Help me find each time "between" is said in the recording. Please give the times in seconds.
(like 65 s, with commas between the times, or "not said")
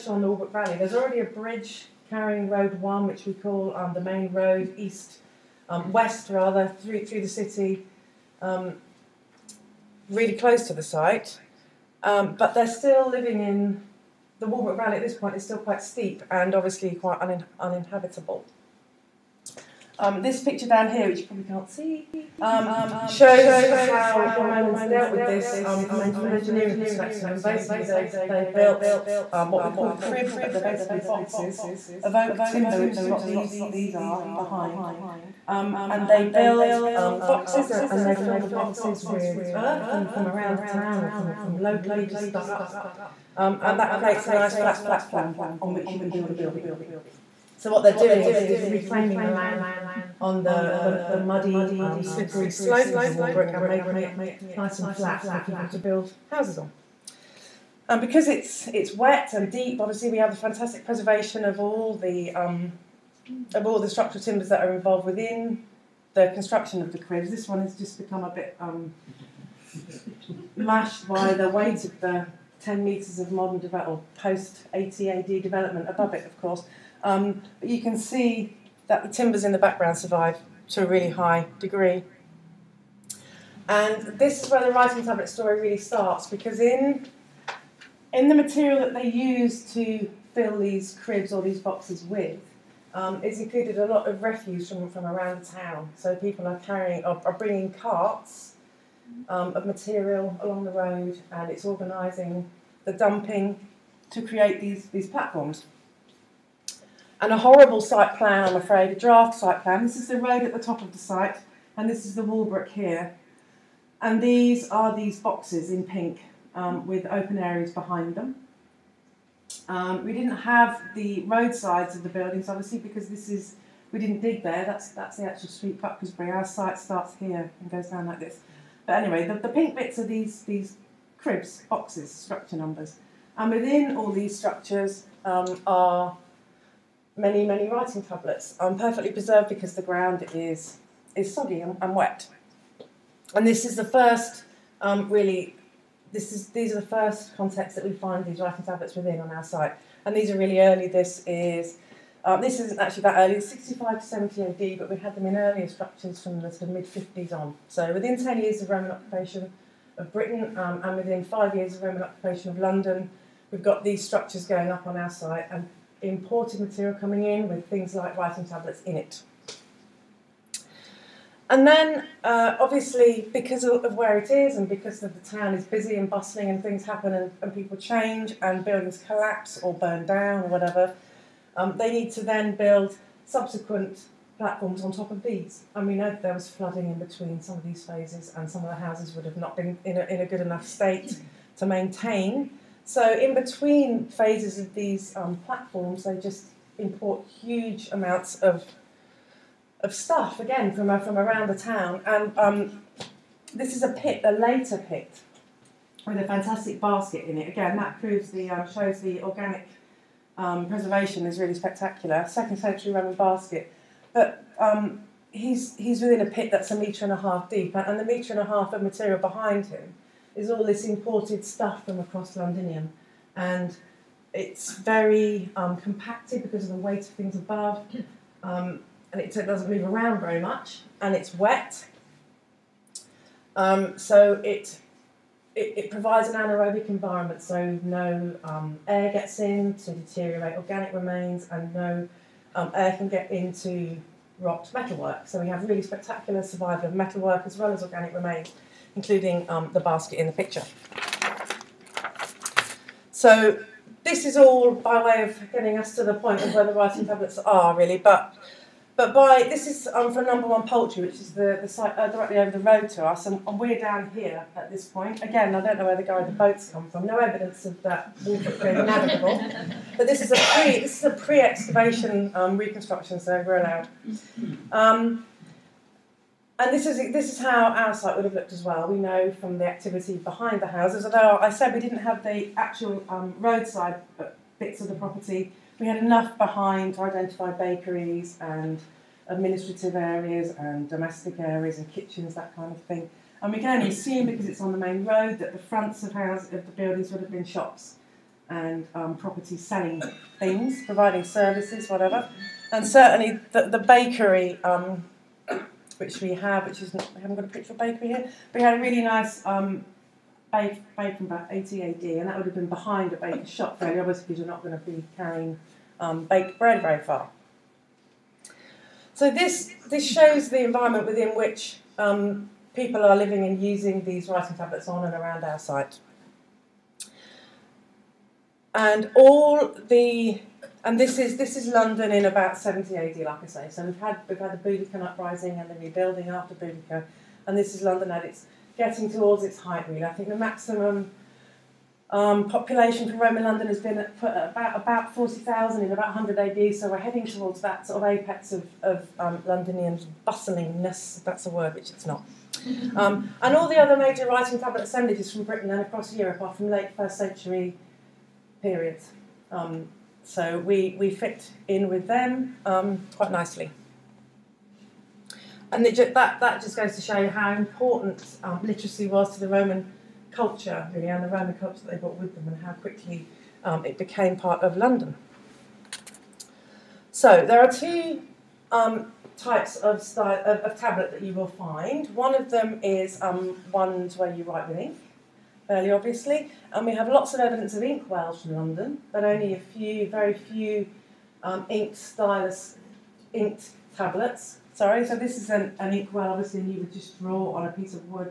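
186 s, 193 s.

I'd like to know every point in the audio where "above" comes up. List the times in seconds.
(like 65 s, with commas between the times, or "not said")
75 s, 227 s.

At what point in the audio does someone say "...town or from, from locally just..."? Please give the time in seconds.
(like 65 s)
40 s.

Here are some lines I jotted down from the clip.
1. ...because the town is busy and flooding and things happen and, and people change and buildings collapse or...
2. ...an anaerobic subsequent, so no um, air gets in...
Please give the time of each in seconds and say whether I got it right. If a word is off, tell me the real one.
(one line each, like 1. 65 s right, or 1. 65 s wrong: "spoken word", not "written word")
1. 174 s wrong: "bustling", not "flooding"
2. 236 s wrong: "environment", not "subsequent".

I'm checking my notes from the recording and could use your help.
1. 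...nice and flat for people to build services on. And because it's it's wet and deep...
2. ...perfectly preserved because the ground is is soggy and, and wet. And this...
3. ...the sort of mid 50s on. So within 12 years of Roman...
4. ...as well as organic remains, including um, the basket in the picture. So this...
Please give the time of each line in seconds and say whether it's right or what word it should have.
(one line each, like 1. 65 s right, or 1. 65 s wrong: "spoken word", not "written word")
1. 54 s wrong: "houses", not "services"
2. 138 s right
3. 156 s wrong: "10", not "12"
4. 247 s right.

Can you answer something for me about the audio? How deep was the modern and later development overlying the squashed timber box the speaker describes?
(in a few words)
10 metres.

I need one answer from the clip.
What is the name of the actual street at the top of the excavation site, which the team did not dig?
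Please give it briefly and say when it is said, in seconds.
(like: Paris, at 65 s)
Bucklersbury, at 125 s.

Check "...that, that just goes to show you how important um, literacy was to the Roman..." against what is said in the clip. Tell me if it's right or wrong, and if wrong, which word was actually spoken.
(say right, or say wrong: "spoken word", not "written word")
right.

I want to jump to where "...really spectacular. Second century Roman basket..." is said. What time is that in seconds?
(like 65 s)
211 s.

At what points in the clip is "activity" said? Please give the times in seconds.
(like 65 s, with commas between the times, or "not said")
279 s.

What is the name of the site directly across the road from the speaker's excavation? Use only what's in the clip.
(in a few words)
Number One Poultry.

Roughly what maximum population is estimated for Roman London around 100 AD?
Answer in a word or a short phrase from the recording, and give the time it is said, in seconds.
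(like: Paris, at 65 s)
40,000, at 345 s.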